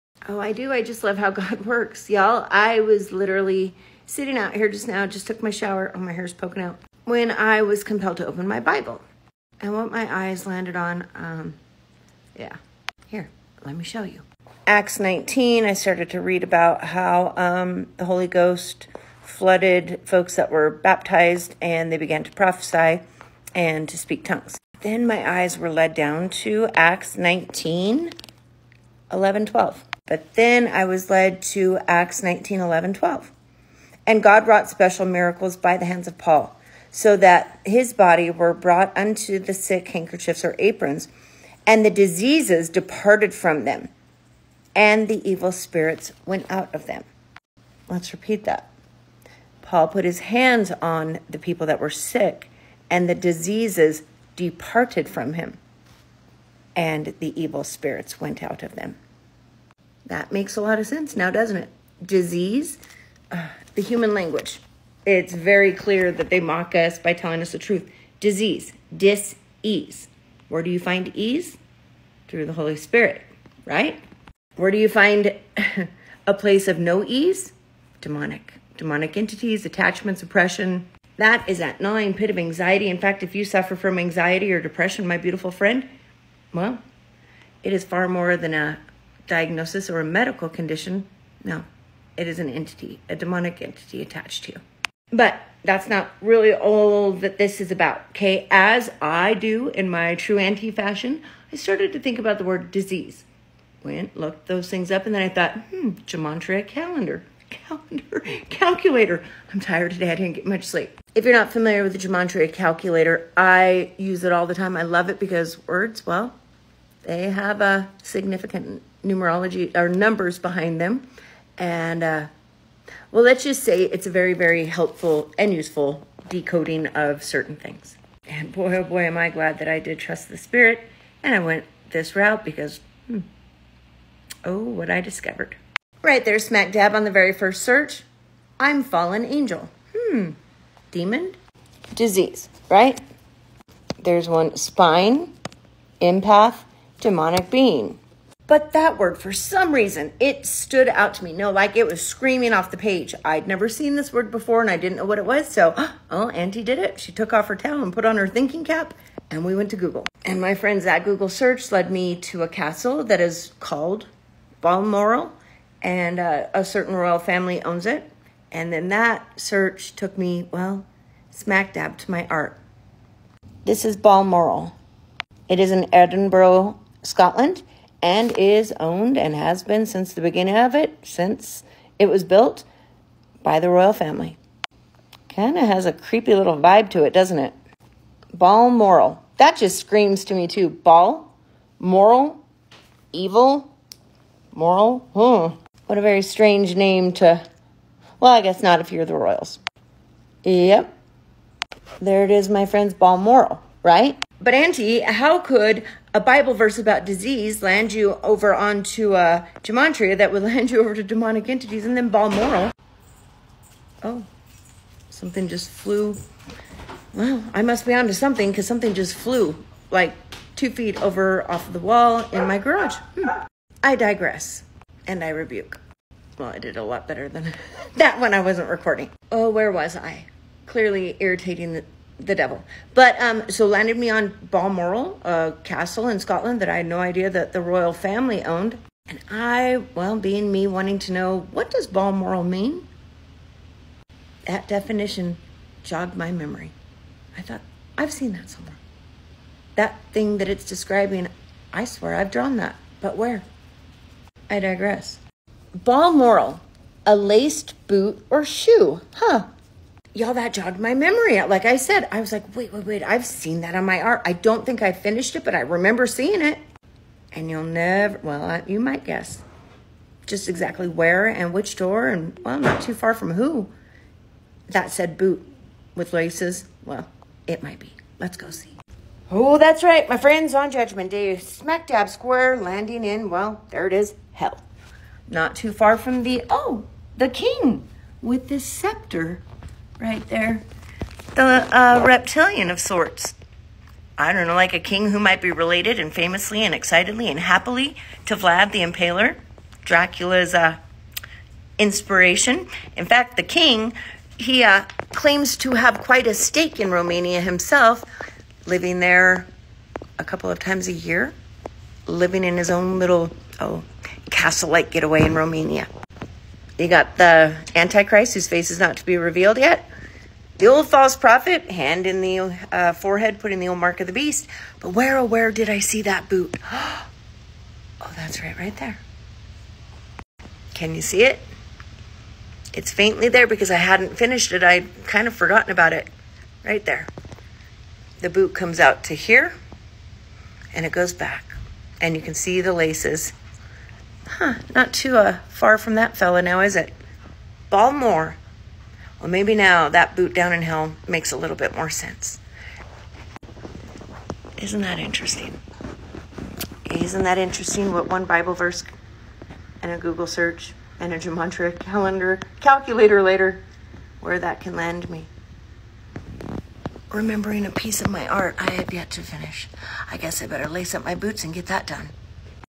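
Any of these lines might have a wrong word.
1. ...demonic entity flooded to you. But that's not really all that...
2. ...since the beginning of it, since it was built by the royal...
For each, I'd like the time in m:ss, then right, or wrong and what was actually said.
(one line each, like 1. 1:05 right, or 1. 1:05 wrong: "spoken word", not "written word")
1. 1:33 wrong: "attached", not "flooded"
2. 2:59 right.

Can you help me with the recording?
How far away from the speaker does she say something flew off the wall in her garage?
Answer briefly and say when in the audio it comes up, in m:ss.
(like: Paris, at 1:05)
2 feet, at 3:40.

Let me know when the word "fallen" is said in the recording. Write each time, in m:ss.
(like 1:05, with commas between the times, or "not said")
2:18.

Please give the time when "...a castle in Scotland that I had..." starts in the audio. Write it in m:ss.
3:55.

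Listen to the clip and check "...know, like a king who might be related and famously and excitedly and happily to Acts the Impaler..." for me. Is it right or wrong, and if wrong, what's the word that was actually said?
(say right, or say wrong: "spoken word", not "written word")
wrong: "Vlad", not "Acts".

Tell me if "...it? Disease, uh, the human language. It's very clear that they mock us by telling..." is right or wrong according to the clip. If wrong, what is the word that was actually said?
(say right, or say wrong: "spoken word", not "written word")
right.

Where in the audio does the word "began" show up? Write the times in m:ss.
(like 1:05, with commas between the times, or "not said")
0:21.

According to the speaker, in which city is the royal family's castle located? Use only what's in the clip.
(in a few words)
Edinburgh.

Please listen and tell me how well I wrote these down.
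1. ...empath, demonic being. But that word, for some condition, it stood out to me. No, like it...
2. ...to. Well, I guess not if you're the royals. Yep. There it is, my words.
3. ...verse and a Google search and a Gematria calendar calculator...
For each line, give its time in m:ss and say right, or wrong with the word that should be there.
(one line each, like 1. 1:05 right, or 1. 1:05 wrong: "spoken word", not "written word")
1. 2:26 wrong: "reason", not "condition"
2. 3:17 wrong: "friends", not "words"
3. 5:58 right.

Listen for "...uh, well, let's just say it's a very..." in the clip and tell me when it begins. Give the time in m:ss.
2:02.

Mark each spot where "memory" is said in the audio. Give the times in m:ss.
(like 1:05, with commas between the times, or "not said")
4:06, 4:20.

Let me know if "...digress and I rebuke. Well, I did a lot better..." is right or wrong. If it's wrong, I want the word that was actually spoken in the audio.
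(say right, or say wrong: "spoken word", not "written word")
right.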